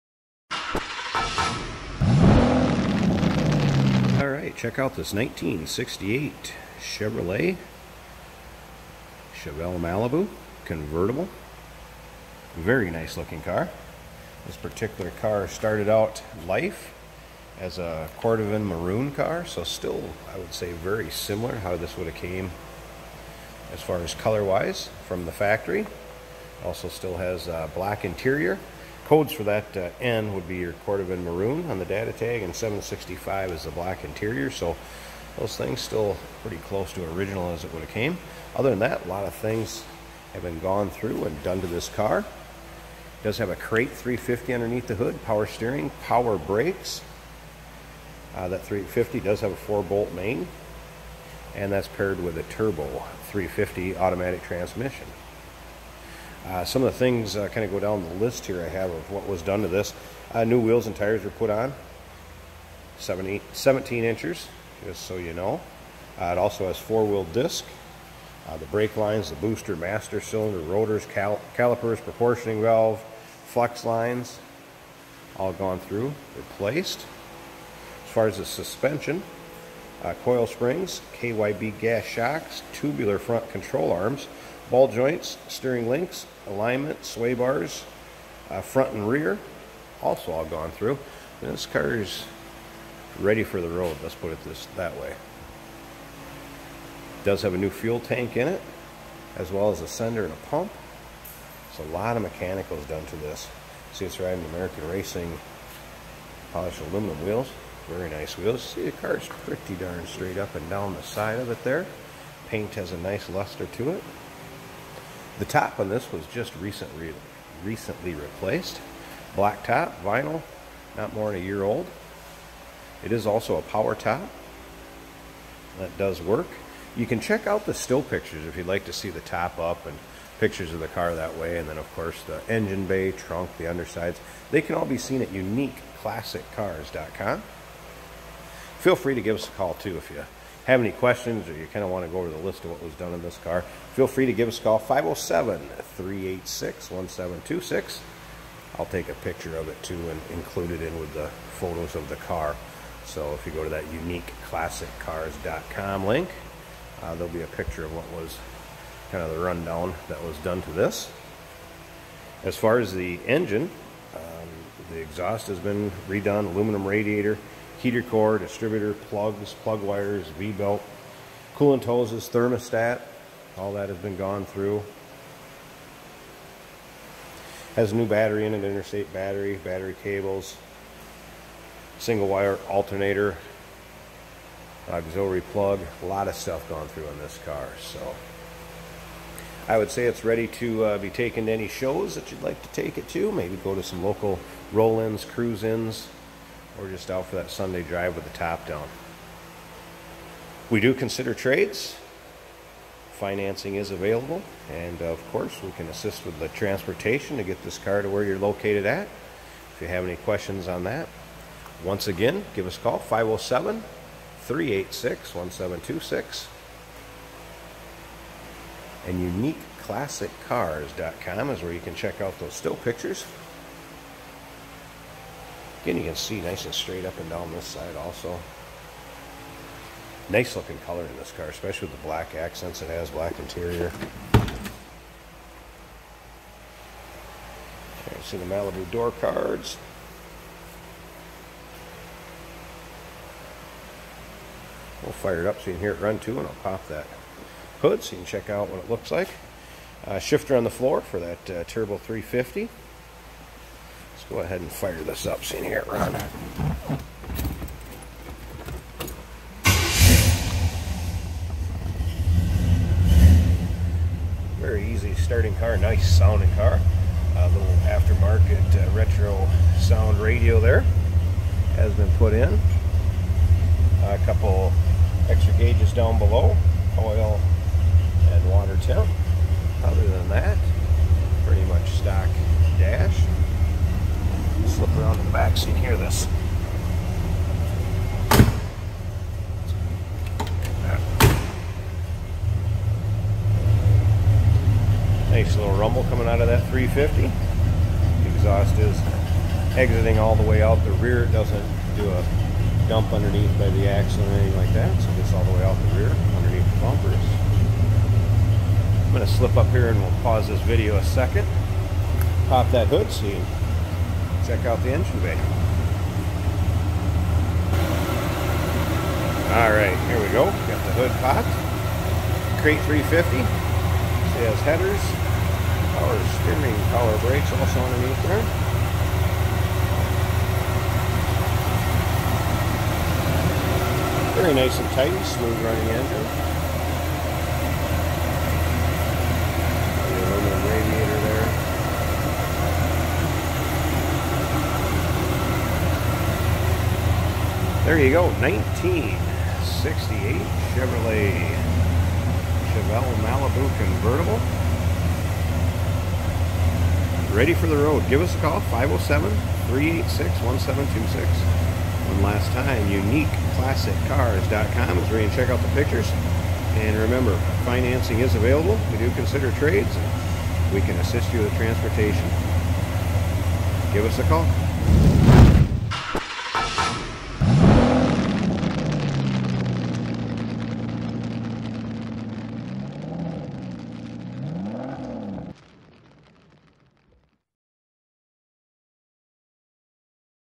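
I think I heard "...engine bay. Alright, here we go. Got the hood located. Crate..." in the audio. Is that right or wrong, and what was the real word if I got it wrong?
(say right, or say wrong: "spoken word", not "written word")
wrong: "popped", not "located".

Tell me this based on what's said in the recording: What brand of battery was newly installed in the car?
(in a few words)
Interstate.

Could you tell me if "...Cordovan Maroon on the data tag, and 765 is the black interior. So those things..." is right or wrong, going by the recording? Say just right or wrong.
right.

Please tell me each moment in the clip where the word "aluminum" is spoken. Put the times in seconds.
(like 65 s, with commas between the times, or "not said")
106 s, 166 s.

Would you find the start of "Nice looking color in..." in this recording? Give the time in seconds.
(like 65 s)
230 s.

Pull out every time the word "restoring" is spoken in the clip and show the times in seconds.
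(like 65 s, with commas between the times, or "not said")
not said.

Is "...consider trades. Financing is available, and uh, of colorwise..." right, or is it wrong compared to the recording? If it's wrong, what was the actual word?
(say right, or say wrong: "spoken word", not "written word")
wrong: "course", not "colorwise".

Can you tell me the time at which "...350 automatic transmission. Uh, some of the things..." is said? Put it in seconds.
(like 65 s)
53 s.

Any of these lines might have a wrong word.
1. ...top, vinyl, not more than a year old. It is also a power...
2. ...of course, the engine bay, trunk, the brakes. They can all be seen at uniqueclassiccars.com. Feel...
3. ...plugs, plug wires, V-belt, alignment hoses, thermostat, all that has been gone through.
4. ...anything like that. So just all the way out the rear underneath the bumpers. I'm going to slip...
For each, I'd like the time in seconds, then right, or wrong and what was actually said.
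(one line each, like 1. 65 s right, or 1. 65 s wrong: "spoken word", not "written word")
1. 119 s right
2. 131 s wrong: "undersides", not "brakes"
3. 168 s wrong: "coolant", not "alignment"
4. 304 s right.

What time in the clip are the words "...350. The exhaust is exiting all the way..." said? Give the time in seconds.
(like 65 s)
296 s.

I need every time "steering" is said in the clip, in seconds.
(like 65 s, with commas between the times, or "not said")
45 s, 85 s, 326 s.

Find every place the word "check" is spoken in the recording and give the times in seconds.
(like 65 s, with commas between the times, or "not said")
4 s, 127 s, 221 s, 248 s, 314 s, 365 s.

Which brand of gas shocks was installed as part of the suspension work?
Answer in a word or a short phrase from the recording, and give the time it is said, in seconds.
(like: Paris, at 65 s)
KYB, at 81 s.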